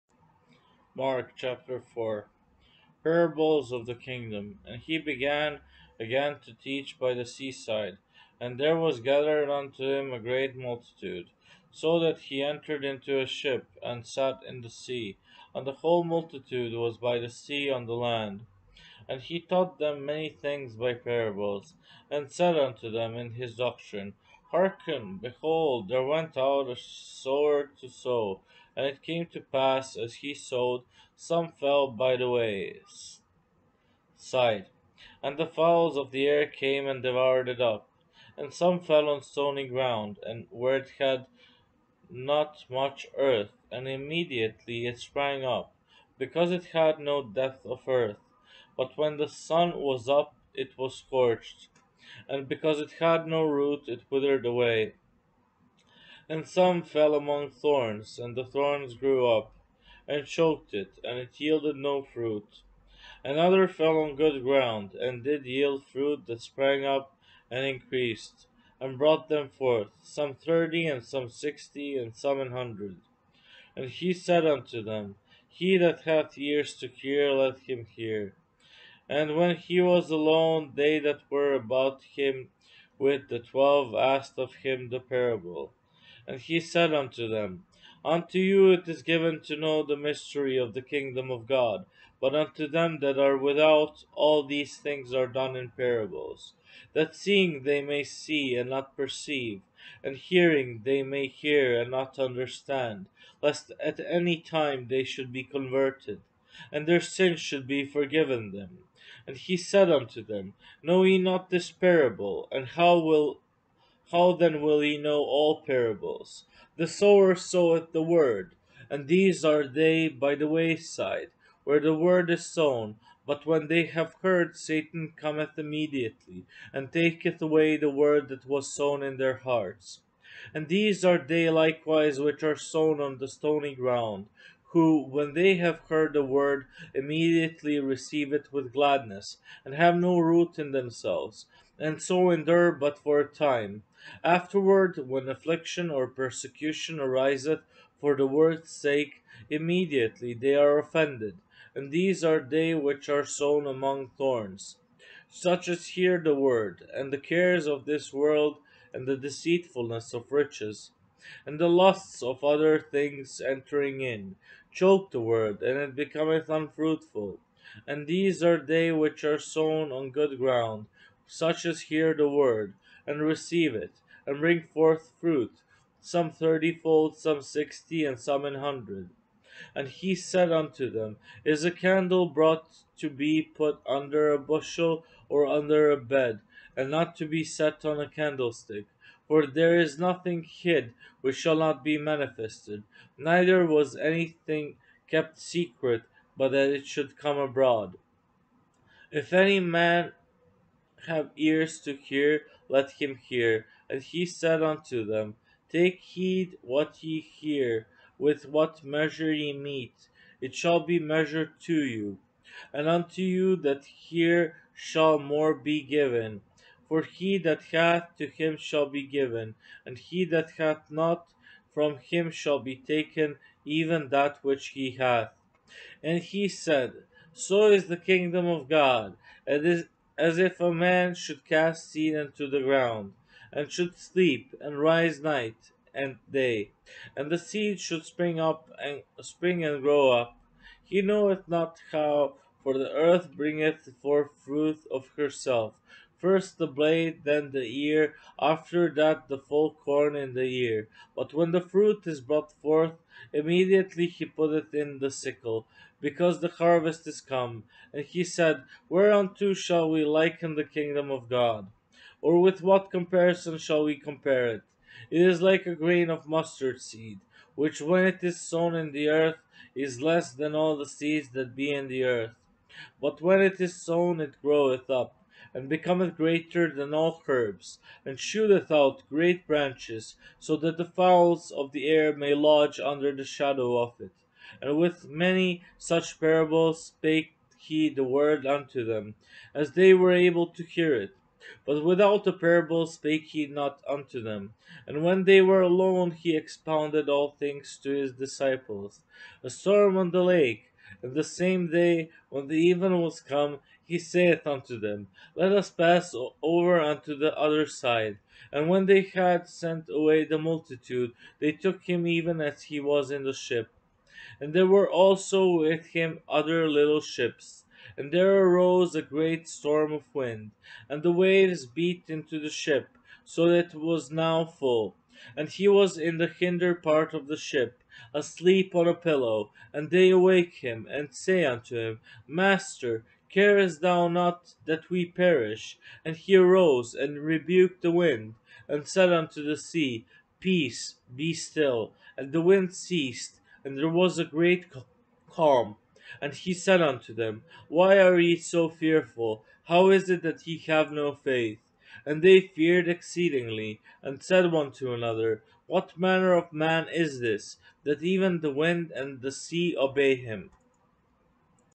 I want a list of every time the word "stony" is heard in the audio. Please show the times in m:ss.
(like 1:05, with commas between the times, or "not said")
0:39, 2:13.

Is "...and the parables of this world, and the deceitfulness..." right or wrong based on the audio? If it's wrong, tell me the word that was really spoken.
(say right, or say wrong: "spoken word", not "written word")
wrong: "cares", not "parables".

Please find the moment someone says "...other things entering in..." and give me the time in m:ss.
2:42.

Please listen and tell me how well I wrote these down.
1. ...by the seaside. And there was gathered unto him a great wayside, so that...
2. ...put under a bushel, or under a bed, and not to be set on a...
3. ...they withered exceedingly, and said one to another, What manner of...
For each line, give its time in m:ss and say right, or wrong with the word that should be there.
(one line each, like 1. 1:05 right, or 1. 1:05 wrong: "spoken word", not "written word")
1. 0:06 wrong: "multitude", not "wayside"
2. 3:03 right
3. 5:52 wrong: "feared", not "withered".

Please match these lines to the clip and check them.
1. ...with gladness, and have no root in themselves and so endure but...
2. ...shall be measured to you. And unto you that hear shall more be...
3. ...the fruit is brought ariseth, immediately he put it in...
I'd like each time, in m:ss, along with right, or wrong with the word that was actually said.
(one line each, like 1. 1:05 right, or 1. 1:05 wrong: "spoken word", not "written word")
1. 2:18 right
2. 3:30 right
3. 4:11 wrong: "forth", not "ariseth".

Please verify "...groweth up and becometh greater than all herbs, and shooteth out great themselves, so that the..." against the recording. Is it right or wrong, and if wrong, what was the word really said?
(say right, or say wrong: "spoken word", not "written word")
wrong: "branches", not "themselves".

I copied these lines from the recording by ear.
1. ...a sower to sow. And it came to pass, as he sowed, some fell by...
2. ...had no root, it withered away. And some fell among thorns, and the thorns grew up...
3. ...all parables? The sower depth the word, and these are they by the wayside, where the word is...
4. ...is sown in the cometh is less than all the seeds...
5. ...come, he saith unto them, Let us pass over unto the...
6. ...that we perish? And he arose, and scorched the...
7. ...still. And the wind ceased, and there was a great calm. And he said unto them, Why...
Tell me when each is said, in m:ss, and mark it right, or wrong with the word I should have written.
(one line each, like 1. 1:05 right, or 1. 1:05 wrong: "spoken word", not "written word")
1. 0:26 right
2. 0:52 right
3. 1:55 wrong: "soweth", not "depth"
4. 4:28 wrong: "earth", not "cometh"
5. 5:03 right
6. 5:34 wrong: "rebuked", not "scorched"
7. 5:41 right.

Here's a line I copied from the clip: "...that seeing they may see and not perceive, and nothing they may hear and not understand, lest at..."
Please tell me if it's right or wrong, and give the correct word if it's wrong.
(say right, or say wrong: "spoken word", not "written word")
wrong: "hearing", not "nothing".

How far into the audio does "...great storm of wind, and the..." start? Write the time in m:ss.
5:19.